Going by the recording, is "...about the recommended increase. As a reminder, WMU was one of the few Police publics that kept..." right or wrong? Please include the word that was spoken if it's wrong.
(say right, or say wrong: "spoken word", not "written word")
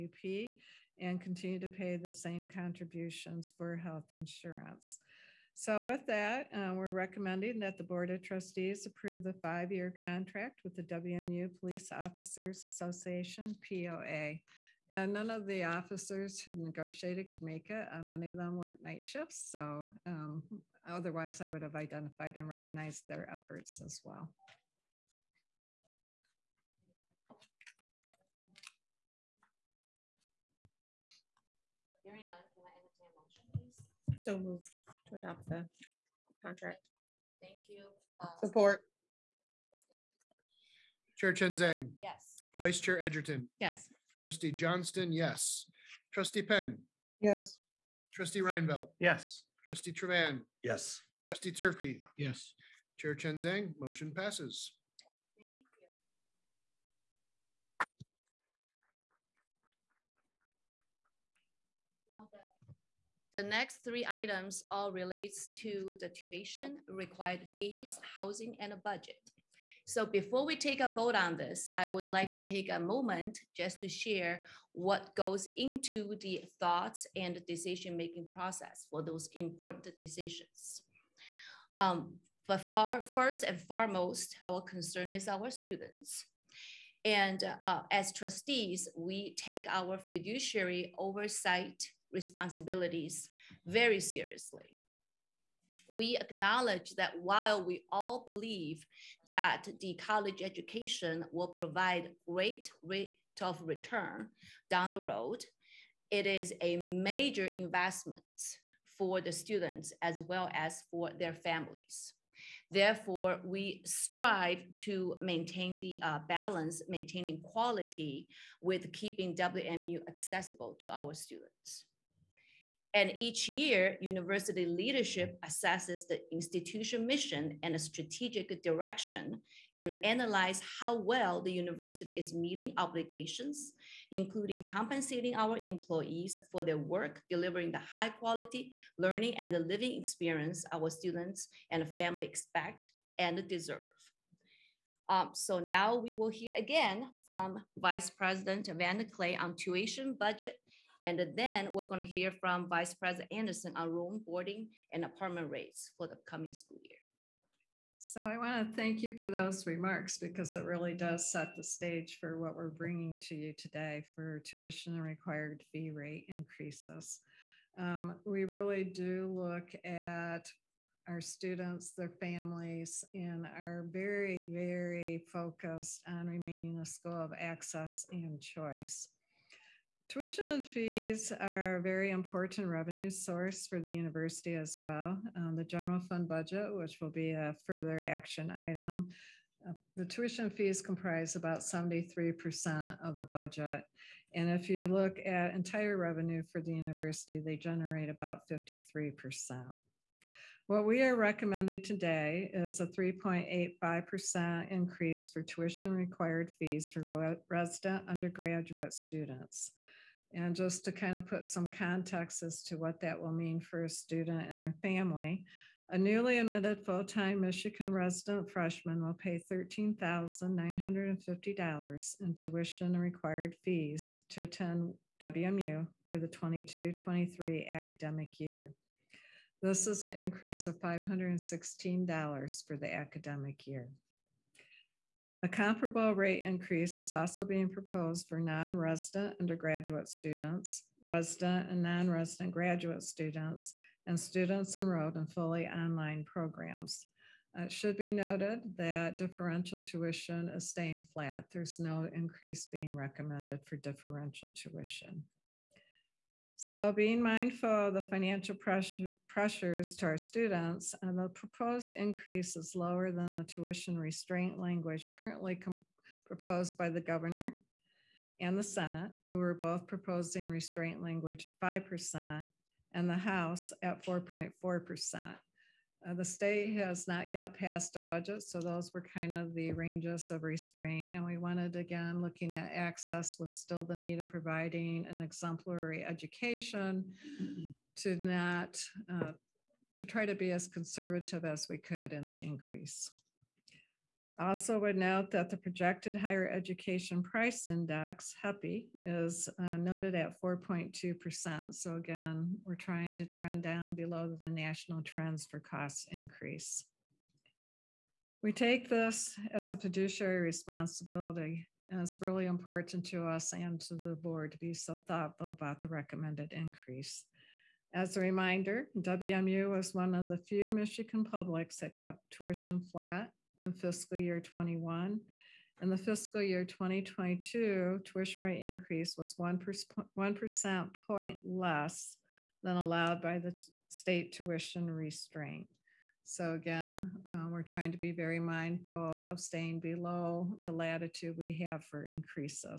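wrong: "Michigan", not "Police".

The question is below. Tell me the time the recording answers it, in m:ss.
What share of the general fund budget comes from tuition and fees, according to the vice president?
3:11.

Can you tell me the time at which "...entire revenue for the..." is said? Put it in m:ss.
3:15.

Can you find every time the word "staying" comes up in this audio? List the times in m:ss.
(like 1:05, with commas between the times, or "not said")
4:10, 5:39.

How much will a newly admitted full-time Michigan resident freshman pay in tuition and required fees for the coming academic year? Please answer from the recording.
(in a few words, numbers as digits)
$13,950.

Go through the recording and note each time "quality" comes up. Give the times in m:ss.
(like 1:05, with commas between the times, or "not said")
1:57, 2:18.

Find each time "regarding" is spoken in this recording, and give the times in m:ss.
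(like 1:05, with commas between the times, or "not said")
not said.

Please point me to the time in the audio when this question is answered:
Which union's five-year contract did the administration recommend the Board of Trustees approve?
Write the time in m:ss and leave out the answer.
0:10.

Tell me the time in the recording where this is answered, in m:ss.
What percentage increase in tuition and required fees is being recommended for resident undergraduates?
3:22.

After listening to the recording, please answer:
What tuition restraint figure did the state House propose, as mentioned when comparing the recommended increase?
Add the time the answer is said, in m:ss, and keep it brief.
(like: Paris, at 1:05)
4.4%, at 4:34.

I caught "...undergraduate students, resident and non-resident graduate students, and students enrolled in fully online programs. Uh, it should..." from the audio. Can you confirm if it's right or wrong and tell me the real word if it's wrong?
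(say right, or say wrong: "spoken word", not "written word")
right.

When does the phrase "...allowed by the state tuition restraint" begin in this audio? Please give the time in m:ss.
5:32.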